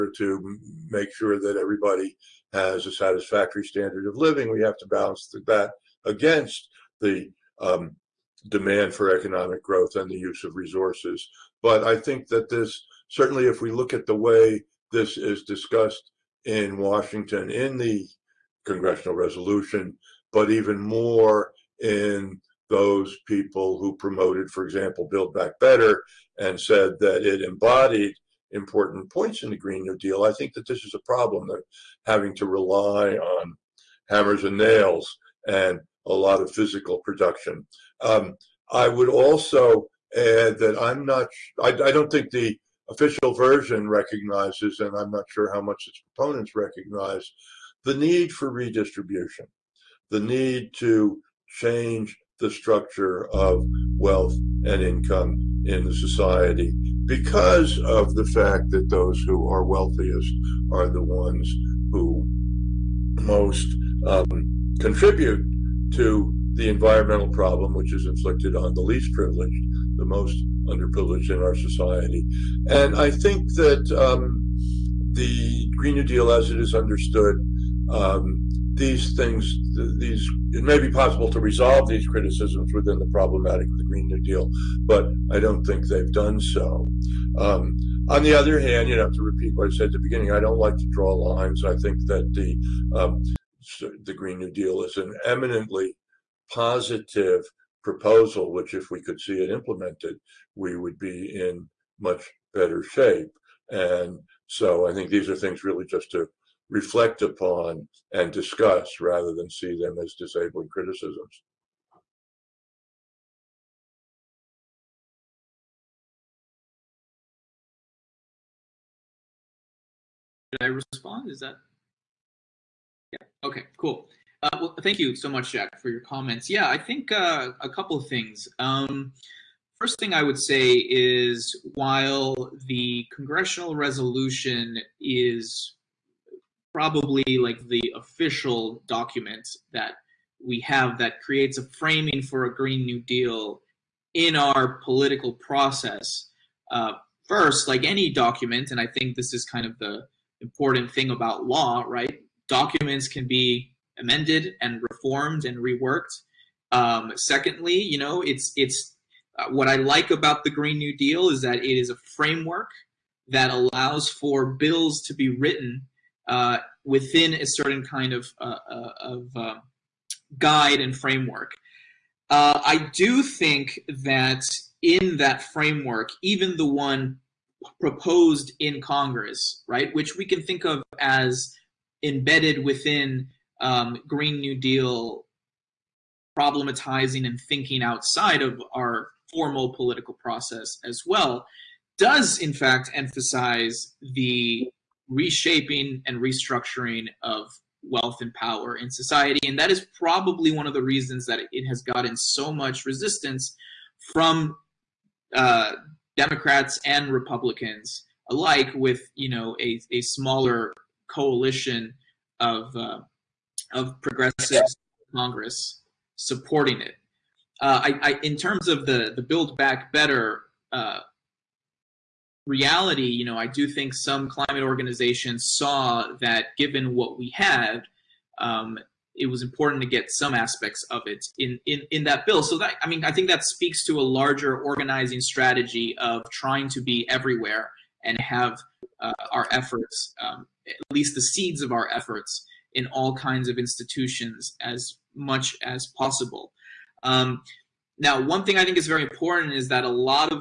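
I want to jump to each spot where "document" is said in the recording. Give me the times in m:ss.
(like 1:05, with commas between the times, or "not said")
2:18, 2:28, 2:32.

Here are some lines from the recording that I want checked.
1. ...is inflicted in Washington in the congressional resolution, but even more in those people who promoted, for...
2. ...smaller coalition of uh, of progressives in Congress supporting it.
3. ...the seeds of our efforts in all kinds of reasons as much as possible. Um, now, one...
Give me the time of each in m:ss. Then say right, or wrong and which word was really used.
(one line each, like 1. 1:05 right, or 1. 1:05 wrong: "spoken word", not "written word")
1. 0:15 wrong: "discussed", not "inflicted"
2. 3:30 right
3. 4:01 wrong: "institutions", not "reasons".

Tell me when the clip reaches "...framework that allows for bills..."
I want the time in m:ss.
2:42.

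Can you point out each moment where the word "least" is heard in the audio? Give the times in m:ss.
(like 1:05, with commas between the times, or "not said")
1:08, 4:00.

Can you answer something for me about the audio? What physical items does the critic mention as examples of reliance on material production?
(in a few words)
hammers and nails.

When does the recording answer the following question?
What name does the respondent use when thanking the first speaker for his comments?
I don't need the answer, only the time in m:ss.
2:05.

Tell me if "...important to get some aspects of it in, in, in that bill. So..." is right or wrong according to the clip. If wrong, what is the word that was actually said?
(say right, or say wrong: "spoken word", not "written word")
right.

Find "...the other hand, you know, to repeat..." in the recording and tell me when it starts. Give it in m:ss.
1:28.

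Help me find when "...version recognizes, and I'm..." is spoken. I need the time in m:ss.
0:43.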